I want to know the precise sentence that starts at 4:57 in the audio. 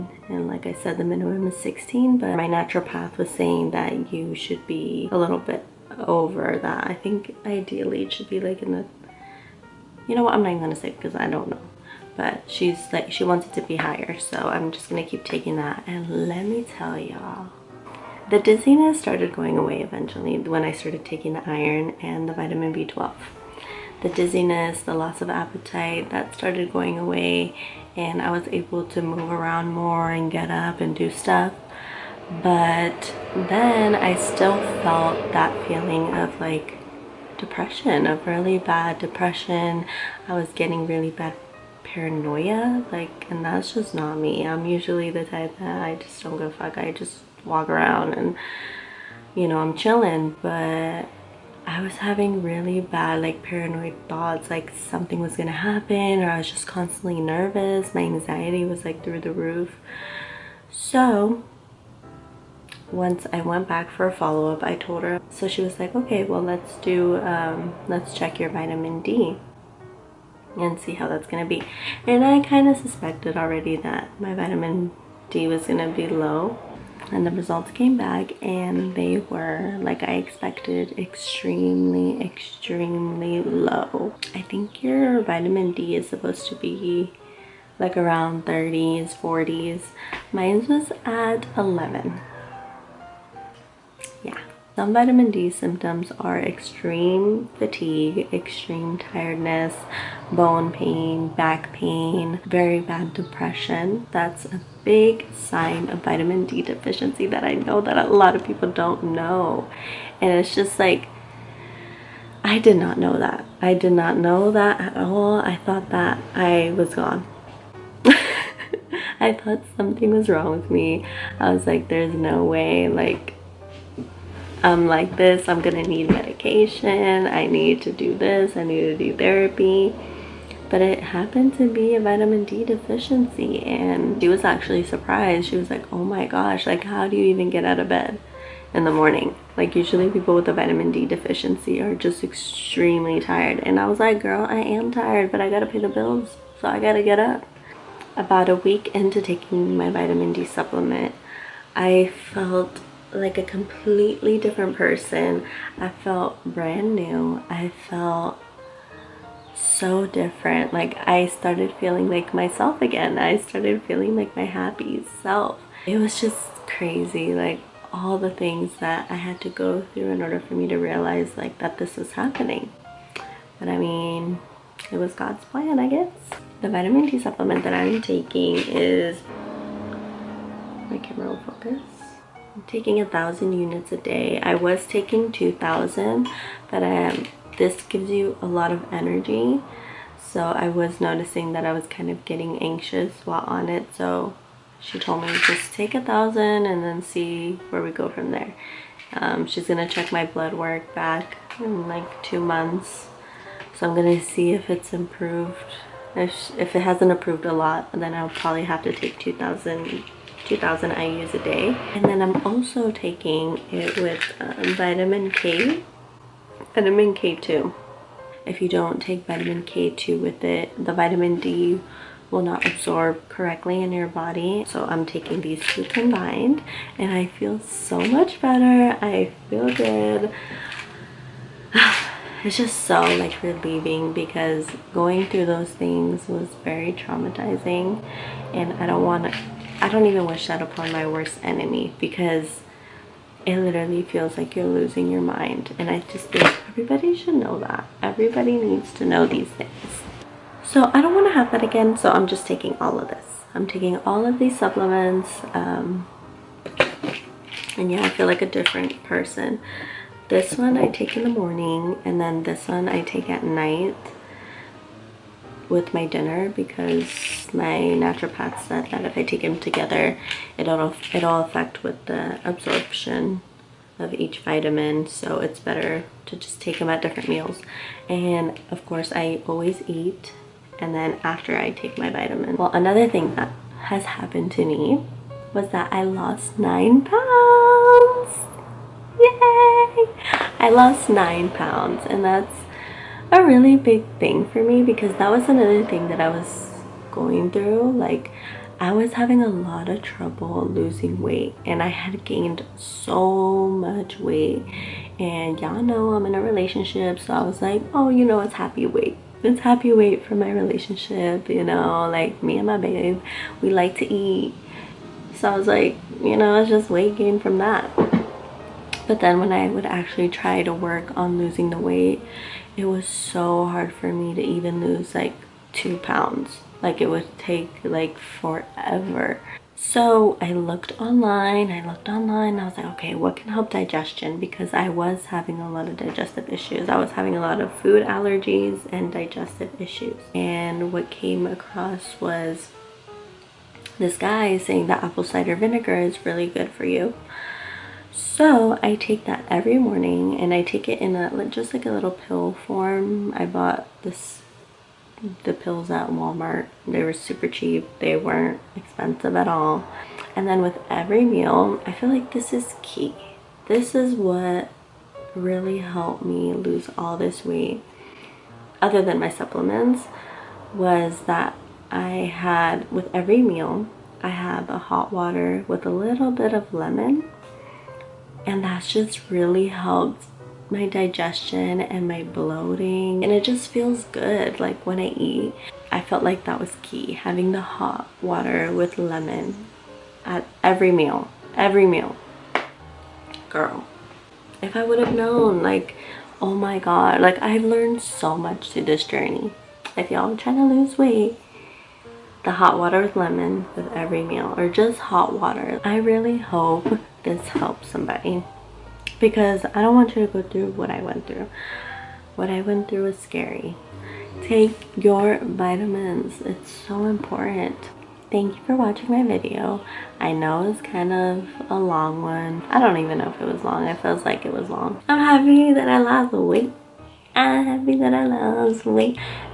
Like, I was having a lot of trouble losing weight and I had gained so much weight.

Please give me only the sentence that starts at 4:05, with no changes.
And I just think everybody should know that.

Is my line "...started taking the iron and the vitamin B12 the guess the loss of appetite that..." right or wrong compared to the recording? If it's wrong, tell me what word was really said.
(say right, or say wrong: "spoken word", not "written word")
wrong: "dizziness", not "guess".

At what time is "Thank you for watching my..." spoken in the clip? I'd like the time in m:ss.
6:58.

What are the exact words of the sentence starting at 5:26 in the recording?
Like it would take like forever.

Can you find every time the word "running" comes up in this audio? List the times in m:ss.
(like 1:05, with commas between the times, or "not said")
not said.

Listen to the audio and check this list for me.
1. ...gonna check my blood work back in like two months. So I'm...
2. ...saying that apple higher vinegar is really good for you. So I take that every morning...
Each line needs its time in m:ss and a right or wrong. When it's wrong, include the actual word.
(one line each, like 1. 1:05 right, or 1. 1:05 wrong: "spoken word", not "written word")
1. 3:19 right
2. 5:44 wrong: "cider", not "higher".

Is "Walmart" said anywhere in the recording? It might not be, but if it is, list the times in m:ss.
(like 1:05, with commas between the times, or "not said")
5:56.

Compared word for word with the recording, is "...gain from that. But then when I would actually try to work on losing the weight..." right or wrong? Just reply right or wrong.
right.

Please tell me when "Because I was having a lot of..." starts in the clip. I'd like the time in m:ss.
5:34.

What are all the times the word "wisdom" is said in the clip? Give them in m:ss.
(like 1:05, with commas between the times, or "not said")
not said.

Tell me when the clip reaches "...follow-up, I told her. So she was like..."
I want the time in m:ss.
1:04.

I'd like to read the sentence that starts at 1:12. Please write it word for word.
And I kind of suspected already that my vitamin D was going to be low.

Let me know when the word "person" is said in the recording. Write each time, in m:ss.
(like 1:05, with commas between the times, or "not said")
2:34, 4:19.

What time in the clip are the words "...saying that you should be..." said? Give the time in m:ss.
0:03.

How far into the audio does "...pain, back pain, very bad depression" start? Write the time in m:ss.
1:40.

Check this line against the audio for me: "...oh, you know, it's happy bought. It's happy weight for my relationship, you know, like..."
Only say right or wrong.
wrong.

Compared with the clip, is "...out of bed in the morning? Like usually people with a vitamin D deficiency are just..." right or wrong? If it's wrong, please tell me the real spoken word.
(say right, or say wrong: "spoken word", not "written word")
right.